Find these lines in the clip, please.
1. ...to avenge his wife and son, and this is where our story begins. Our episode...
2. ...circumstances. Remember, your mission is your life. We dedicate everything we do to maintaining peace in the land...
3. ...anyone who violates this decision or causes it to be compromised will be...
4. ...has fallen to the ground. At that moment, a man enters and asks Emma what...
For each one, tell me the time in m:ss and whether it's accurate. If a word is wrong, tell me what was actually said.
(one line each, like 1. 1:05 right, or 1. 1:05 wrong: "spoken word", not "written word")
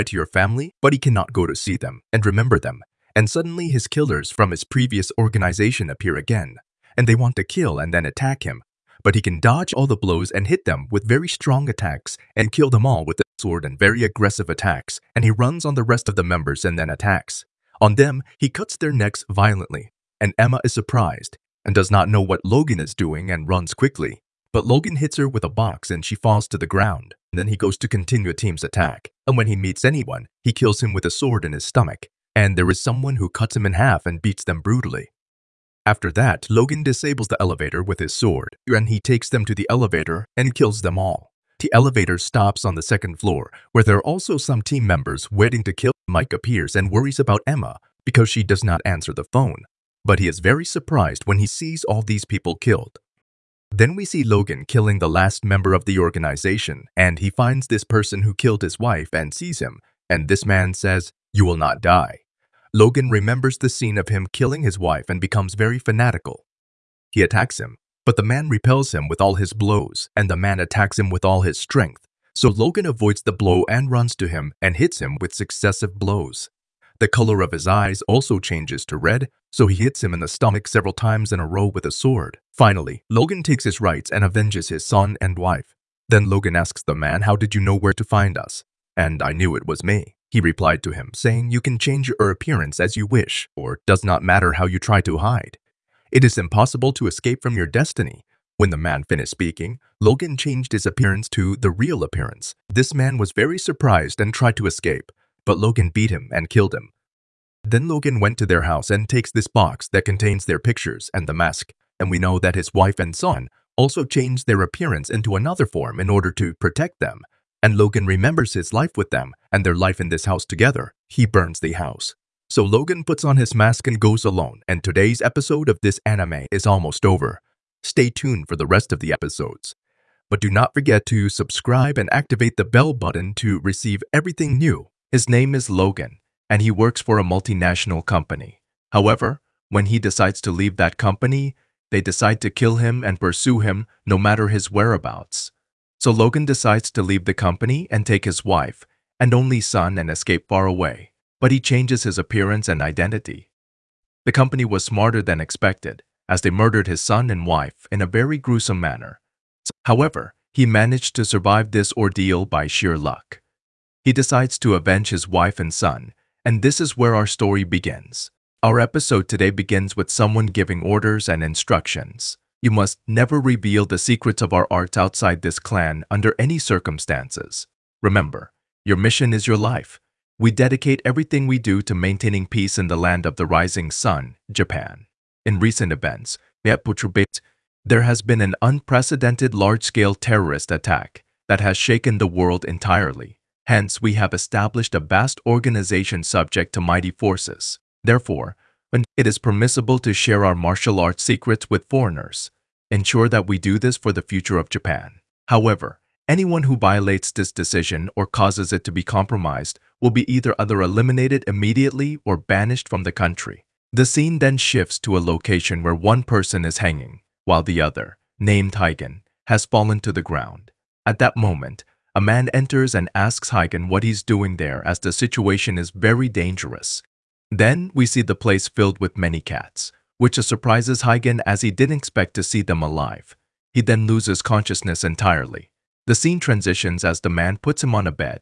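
1. 2:44 right
2. 2:56 right
3. 3:26 right
4. 3:39 wrong: "Hagen", not "Emma".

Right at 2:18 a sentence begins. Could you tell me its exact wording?
However, when he decides to leave that company, they decide to kill him and pursue him no matter his whereabouts.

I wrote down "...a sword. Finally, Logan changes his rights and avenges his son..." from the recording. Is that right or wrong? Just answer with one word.
wrong.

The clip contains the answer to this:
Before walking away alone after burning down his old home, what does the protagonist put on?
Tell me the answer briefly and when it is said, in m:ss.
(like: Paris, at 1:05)
His mask, at 2:03.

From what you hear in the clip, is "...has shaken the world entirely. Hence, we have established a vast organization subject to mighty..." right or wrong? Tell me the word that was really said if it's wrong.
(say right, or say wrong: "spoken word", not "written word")
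right.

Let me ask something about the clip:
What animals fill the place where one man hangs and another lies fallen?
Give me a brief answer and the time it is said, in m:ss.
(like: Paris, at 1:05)
Cats, at 3:49.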